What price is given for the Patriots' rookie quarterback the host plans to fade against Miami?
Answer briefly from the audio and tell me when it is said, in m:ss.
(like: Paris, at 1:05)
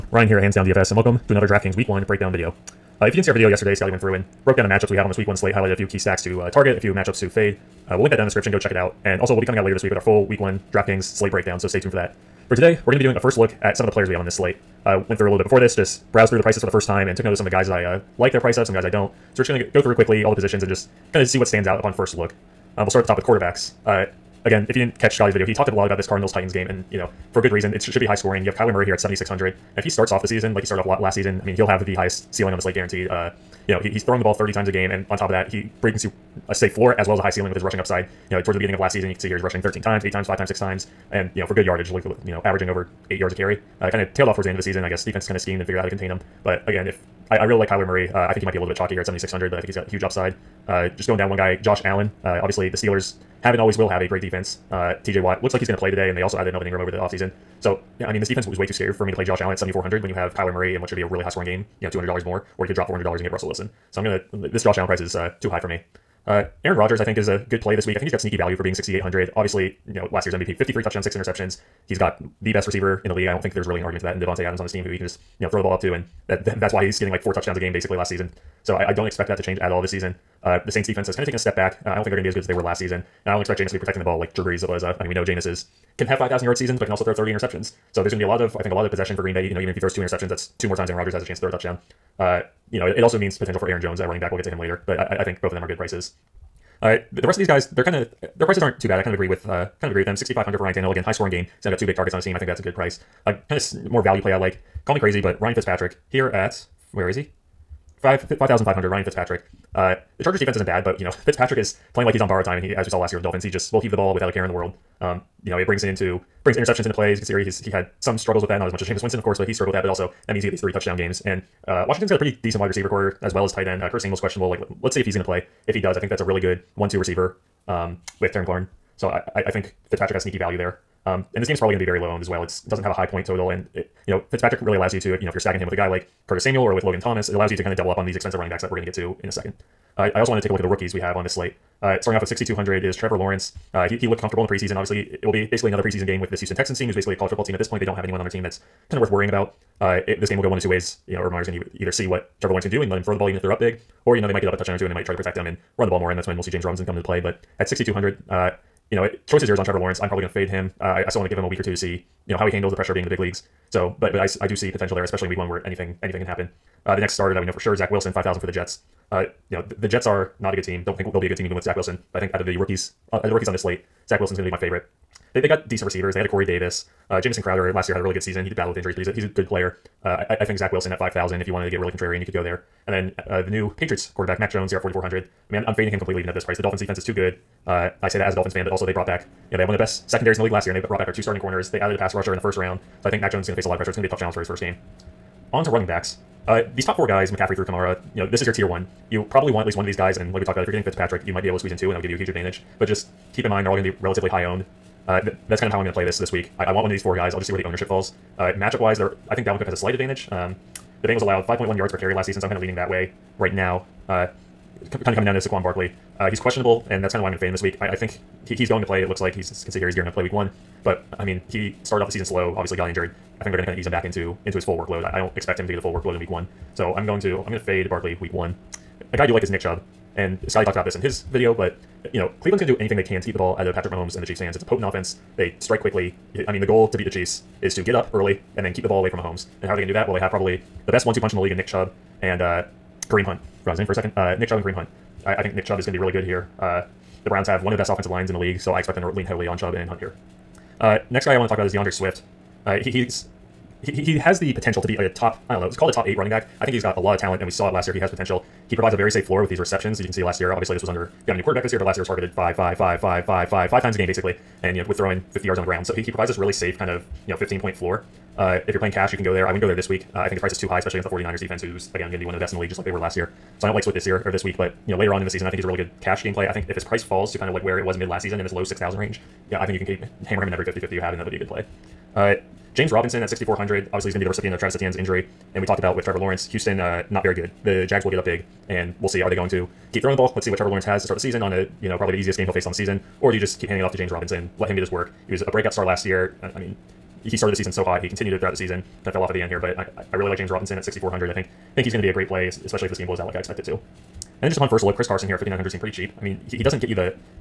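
$4,400, at 3:04.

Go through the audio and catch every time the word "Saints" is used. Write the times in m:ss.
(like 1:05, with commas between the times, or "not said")
1:20.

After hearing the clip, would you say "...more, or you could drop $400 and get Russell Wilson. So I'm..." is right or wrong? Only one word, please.
right.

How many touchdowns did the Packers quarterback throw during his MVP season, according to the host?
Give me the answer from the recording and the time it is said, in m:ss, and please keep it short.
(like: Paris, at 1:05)
53, at 1:10.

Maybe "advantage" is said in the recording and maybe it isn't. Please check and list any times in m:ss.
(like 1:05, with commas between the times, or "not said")
3:22, 3:29.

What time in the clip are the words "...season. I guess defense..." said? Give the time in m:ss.
0:44.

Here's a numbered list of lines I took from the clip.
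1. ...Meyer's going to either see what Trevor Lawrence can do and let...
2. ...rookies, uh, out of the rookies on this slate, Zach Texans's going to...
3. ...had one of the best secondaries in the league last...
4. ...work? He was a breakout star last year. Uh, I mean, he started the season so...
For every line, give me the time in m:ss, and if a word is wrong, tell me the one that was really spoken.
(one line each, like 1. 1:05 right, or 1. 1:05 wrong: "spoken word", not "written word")
1. 2:31 right
2. 2:52 wrong: "Wilson", not "Texans"
3. 3:09 right
4. 4:54 right.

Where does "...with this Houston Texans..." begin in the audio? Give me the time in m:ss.
2:26.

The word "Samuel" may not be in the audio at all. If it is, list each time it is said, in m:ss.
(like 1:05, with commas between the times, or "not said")
2:04, 2:16.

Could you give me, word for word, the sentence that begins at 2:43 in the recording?
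So, but but I, I do see potential there, especially in week one where anything anything can happen.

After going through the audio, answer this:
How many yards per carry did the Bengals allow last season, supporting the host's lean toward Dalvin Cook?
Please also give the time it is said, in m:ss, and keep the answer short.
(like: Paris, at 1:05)
5.1, at 3:31.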